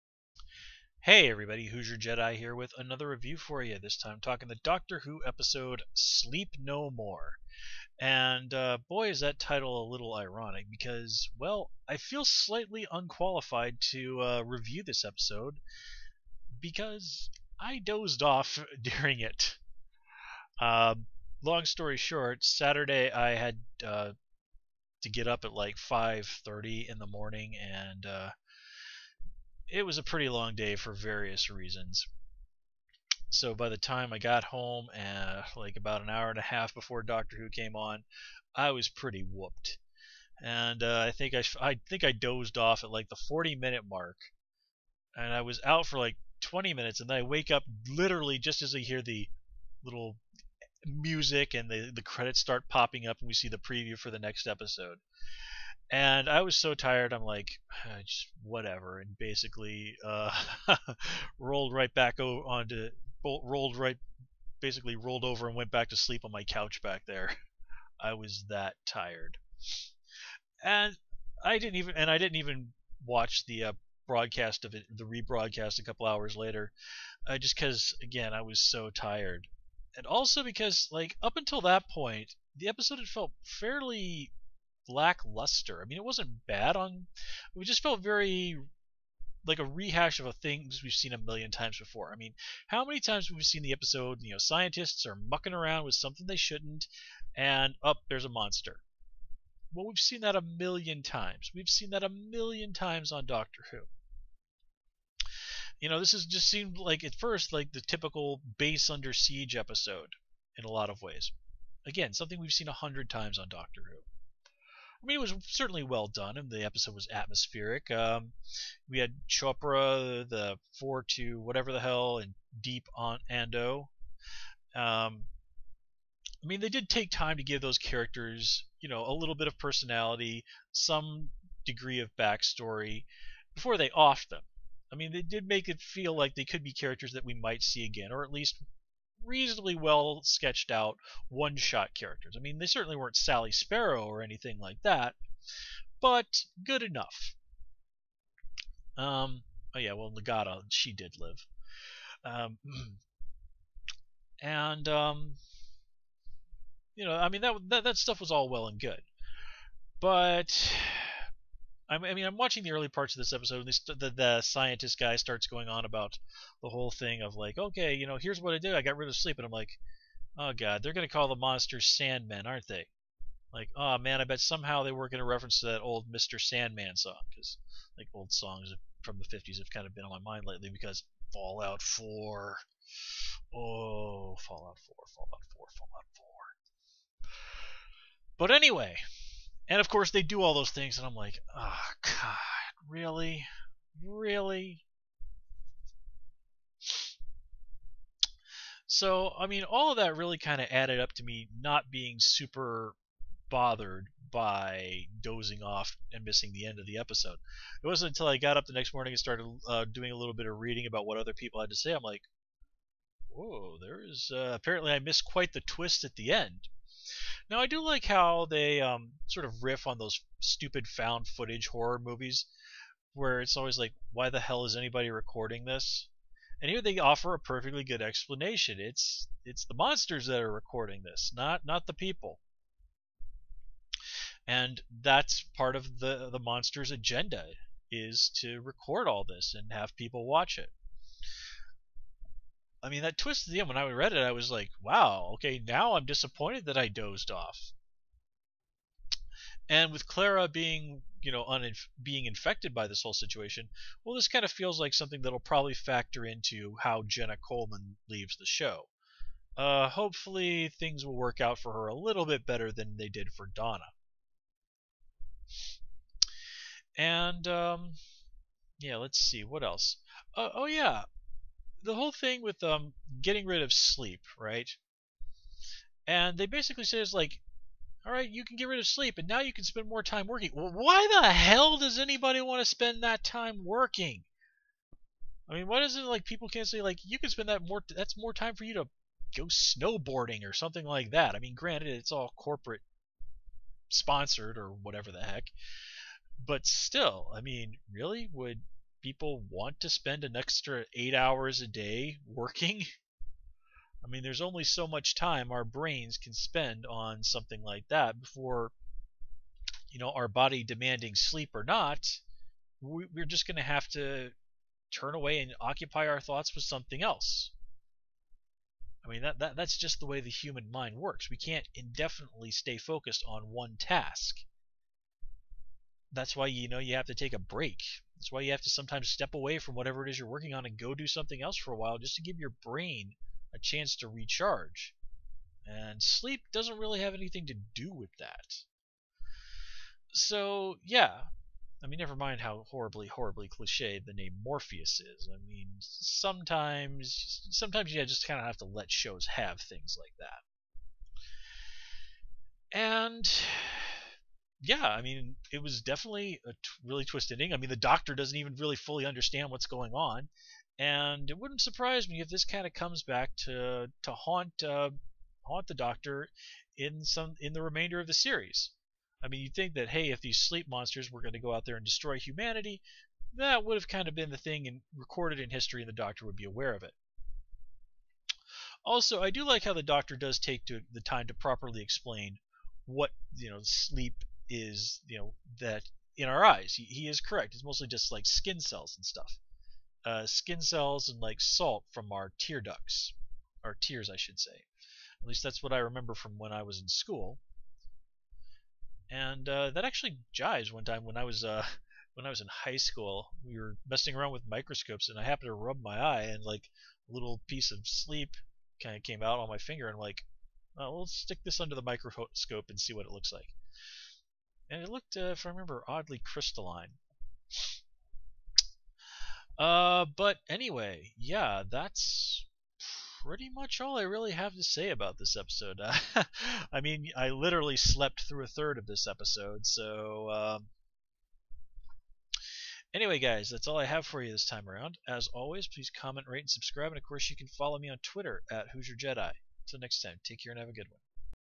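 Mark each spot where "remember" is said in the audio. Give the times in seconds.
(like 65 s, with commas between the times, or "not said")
395 s, 415 s.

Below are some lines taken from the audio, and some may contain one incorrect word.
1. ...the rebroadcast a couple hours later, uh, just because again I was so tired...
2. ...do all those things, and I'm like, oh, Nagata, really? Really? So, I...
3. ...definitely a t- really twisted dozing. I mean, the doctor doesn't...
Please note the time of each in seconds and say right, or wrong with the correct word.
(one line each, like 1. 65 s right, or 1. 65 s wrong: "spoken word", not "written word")
1. 74 s right
2. 190 s wrong: "God", not "Nagata"
3. 355 s wrong: "ending", not "dozing".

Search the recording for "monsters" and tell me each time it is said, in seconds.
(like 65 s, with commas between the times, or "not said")
98 s, 171 s, 229 s, 236 s, 370 s.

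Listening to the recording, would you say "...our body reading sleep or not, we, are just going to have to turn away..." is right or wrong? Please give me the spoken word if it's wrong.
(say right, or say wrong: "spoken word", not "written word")
wrong: "demanding", not "reading".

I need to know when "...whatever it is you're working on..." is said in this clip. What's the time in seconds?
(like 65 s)
329 s.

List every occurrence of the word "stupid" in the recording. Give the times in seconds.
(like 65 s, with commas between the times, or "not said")
220 s.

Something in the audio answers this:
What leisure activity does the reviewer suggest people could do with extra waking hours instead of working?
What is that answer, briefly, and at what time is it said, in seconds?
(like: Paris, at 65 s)
snowboarding, at 289 s.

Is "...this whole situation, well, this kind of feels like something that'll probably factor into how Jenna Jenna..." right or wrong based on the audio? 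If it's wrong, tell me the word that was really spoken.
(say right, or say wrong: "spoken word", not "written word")
wrong: "Coleman", not "Jenna".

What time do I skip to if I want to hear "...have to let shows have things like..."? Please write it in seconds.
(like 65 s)
348 s.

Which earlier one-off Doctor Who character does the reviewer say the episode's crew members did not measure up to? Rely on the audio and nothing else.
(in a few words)
Sally Sparrow.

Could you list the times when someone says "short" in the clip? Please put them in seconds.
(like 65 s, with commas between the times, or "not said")
21 s.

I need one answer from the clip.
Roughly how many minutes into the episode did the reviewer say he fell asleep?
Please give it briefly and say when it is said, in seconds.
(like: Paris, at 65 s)
40, at 43 s.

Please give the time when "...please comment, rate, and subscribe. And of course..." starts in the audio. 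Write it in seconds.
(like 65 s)
435 s.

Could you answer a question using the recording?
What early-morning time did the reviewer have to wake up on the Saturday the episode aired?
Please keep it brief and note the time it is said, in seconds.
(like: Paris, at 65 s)
5:30, at 25 s.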